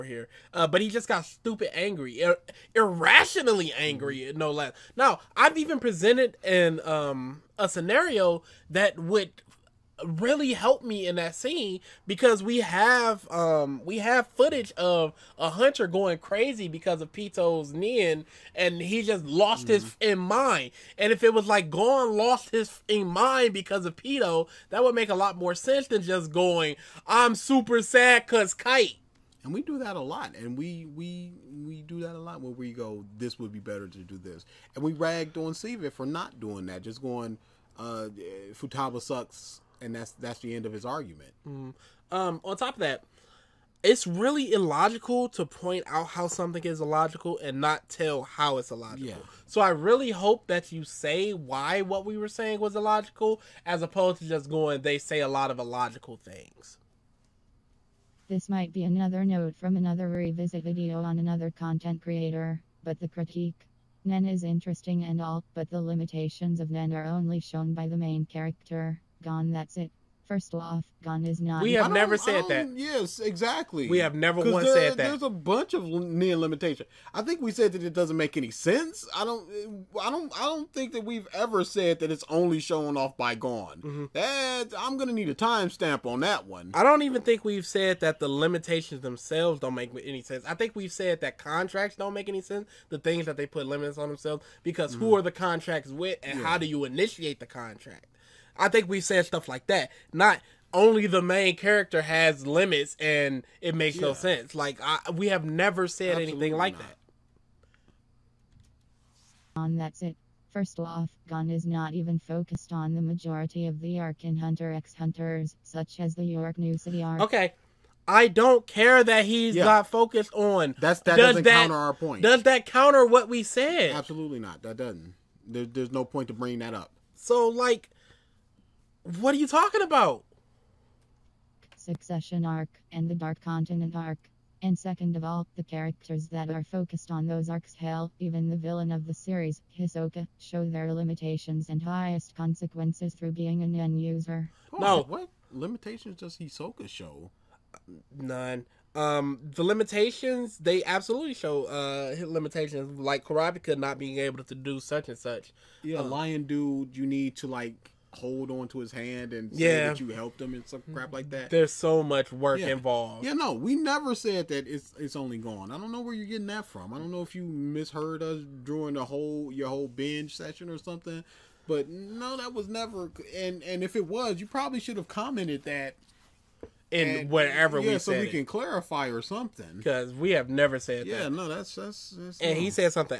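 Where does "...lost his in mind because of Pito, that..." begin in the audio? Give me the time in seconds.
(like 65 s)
22 s.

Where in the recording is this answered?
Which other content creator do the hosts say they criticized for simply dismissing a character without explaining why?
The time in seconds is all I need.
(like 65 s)
35 s.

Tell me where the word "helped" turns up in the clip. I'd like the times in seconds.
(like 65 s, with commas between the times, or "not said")
10 s, 160 s.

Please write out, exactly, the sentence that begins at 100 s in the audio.
Not only the main character has limits and it makes yeah.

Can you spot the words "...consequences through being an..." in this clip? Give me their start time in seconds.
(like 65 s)
142 s.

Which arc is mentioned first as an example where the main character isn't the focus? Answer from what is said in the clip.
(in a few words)
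York New City arc.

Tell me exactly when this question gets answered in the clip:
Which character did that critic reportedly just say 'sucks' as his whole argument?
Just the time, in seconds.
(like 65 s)
38 s.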